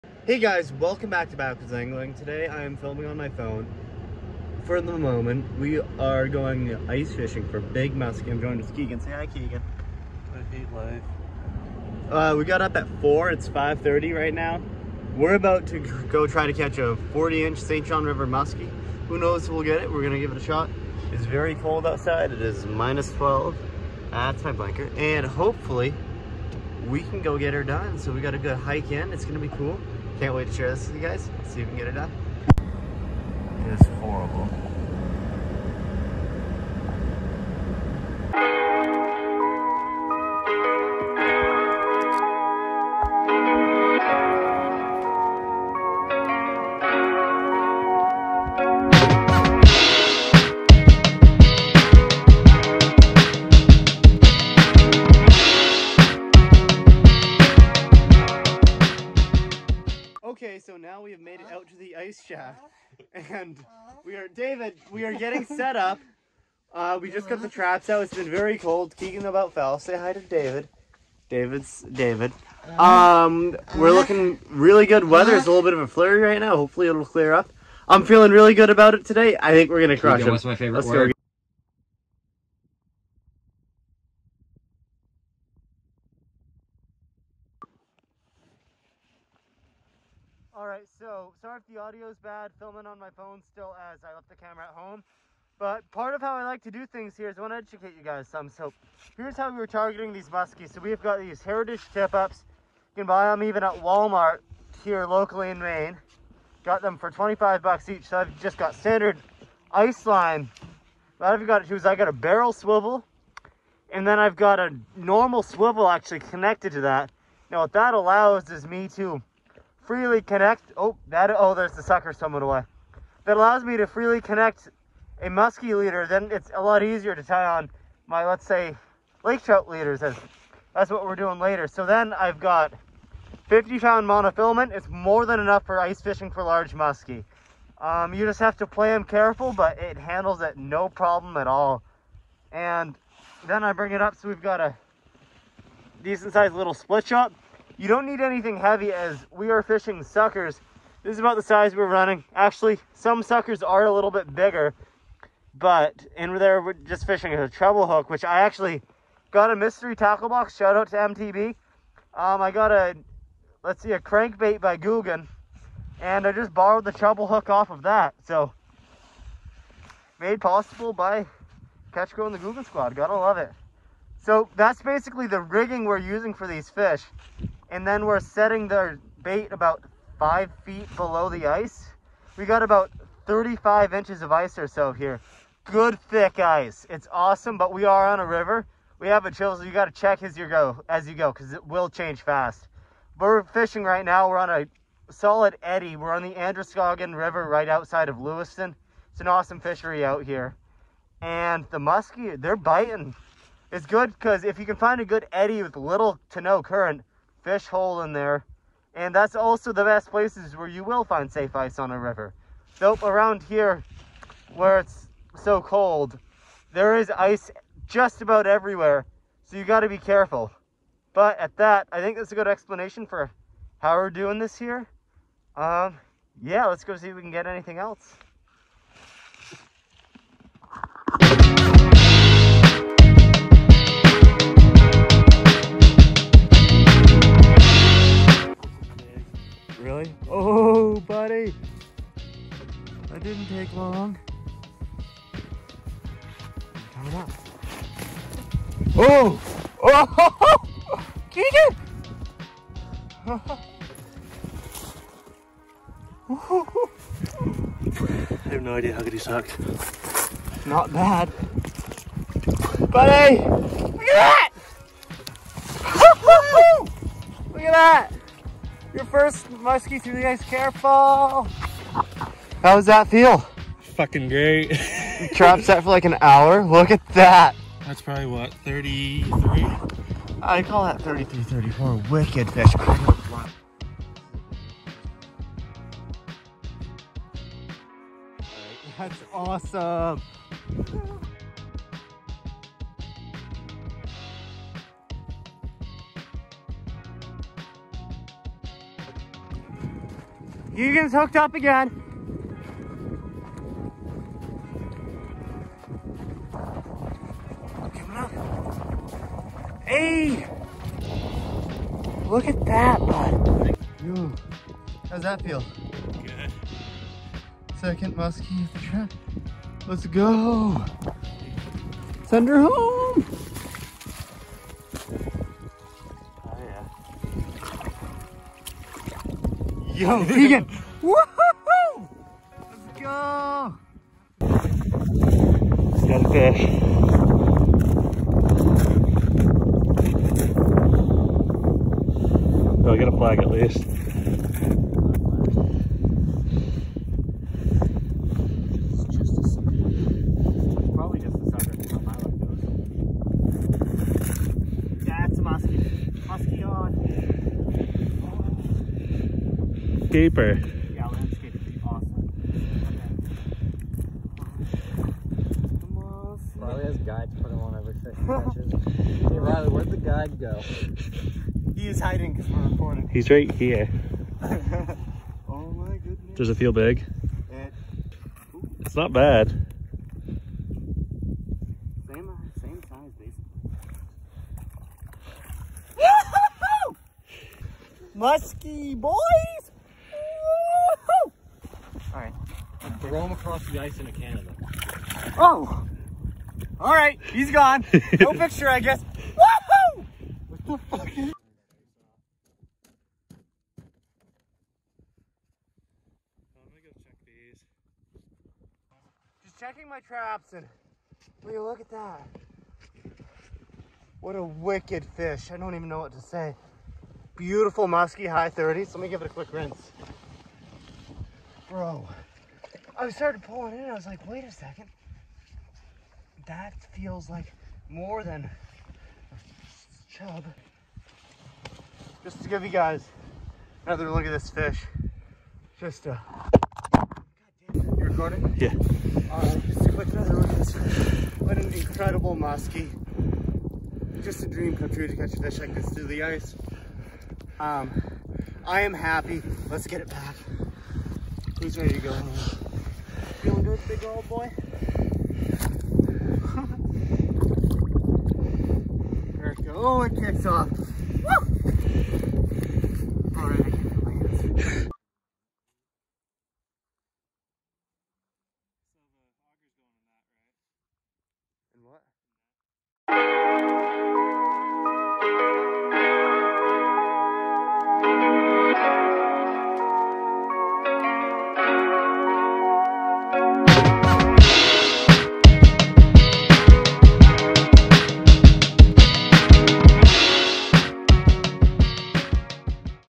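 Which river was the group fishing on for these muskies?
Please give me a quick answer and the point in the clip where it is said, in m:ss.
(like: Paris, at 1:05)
Androscoggin River, at 3:16.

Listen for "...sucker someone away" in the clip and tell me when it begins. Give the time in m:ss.
2:01.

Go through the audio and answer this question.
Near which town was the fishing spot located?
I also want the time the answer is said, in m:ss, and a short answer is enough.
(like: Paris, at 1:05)
Lewiston, at 3:18.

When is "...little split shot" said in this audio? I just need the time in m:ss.
2:26.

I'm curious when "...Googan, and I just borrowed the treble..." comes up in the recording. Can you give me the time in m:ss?
2:44.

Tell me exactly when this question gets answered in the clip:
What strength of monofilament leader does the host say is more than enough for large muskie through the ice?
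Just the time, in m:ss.
2:13.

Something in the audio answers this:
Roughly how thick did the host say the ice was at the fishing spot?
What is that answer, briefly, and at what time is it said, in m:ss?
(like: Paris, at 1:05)
35 inches, at 3:03.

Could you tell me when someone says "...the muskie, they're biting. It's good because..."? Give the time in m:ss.
3:21.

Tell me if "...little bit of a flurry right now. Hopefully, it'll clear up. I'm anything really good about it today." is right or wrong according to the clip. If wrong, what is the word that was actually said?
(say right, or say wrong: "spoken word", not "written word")
wrong: "feeling", not "anything".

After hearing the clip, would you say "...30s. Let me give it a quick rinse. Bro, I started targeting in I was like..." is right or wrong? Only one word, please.
wrong.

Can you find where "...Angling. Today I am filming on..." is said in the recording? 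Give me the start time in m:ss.
0:01.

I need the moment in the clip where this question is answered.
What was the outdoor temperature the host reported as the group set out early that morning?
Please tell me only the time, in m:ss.
0:22.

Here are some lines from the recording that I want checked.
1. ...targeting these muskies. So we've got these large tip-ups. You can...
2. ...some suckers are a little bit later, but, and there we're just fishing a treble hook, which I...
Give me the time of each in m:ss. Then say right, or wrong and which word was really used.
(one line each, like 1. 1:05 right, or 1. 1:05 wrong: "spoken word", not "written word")
1. 1:39 wrong: "heritage", not "large"
2. 2:32 wrong: "bigger", not "later".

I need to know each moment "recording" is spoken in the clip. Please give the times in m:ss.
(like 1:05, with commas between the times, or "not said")
6:12, 7:17.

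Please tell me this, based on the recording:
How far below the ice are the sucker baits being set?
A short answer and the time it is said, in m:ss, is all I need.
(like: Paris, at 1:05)
5 feet, at 3:00.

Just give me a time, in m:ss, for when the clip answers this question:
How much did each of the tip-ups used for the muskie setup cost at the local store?
1:47.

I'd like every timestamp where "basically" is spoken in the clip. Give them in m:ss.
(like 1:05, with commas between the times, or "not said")
2:54, 6:25.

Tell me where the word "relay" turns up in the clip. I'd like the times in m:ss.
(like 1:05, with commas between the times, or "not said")
not said.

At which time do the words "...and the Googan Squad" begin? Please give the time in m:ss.
2:52.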